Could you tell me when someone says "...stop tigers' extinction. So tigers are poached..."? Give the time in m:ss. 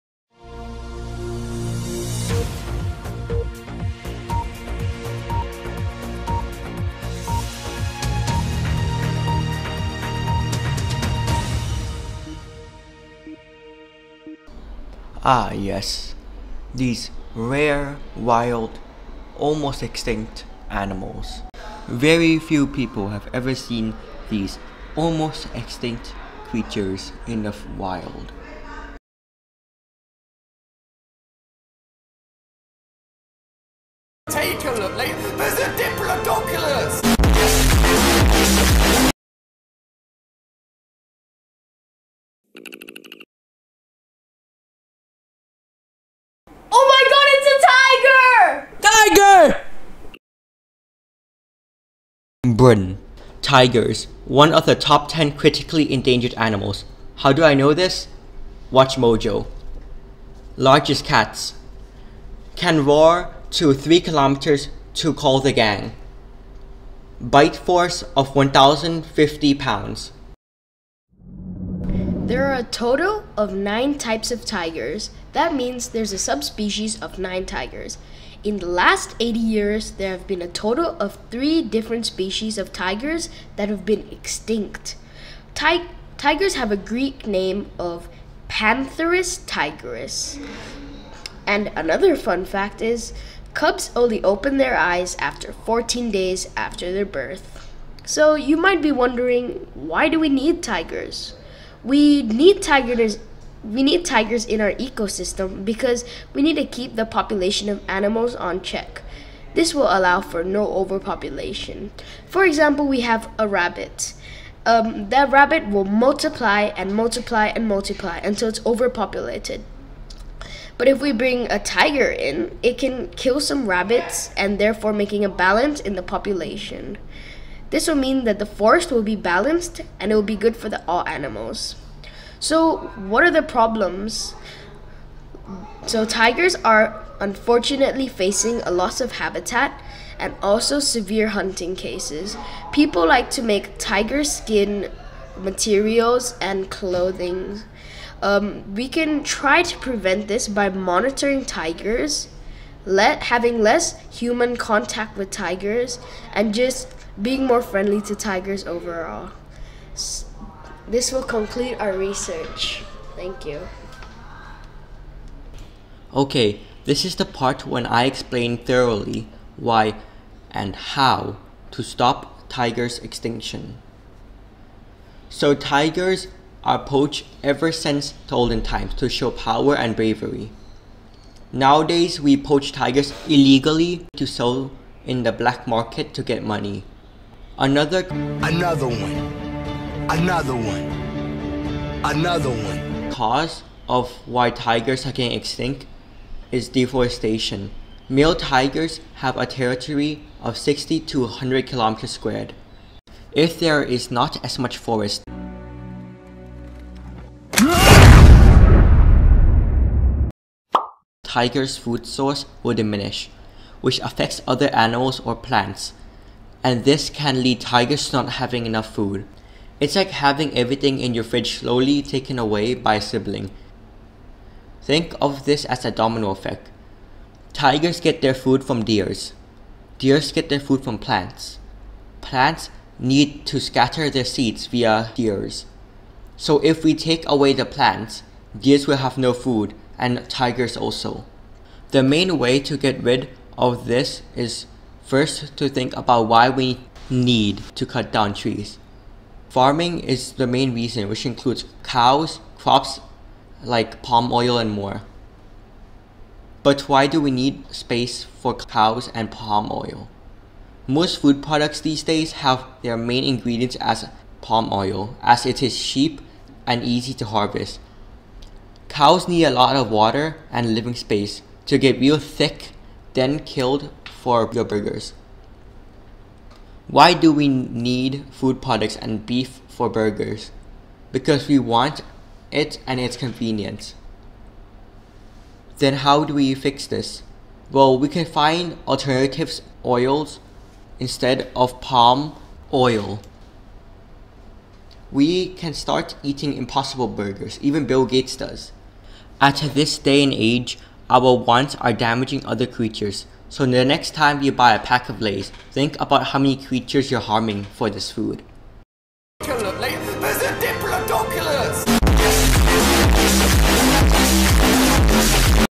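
2:51.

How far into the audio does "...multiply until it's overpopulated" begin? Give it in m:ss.
1:57.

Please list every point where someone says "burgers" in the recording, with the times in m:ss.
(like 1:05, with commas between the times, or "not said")
4:34, 4:39, 4:57.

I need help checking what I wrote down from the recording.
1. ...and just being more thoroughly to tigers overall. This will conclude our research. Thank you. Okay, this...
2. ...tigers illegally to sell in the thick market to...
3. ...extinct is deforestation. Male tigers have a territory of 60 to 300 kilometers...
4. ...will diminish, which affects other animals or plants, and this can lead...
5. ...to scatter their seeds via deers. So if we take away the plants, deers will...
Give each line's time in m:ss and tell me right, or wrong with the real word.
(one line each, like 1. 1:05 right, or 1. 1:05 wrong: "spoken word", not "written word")
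1. 2:36 wrong: "friendly", not "thoroughly"
2. 3:02 wrong: "black", not "thick"
3. 3:15 wrong: "100", not "300"
4. 3:32 right
5. 3:53 right.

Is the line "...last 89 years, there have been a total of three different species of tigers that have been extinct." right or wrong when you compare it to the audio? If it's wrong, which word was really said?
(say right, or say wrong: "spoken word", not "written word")
wrong: "80", not "89".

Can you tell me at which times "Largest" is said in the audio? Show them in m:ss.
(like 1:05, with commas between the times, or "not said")
1:00.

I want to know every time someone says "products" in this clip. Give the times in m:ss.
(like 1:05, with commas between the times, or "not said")
4:21, 4:38.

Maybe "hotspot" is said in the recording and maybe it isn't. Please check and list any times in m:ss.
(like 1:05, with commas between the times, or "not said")
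not said.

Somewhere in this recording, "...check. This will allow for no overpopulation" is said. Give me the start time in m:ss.
1:48.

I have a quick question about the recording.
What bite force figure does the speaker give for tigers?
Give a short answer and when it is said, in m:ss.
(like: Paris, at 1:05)
1,050 pounds, at 1:08.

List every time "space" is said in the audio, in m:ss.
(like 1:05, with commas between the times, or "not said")
4:17, 4:30.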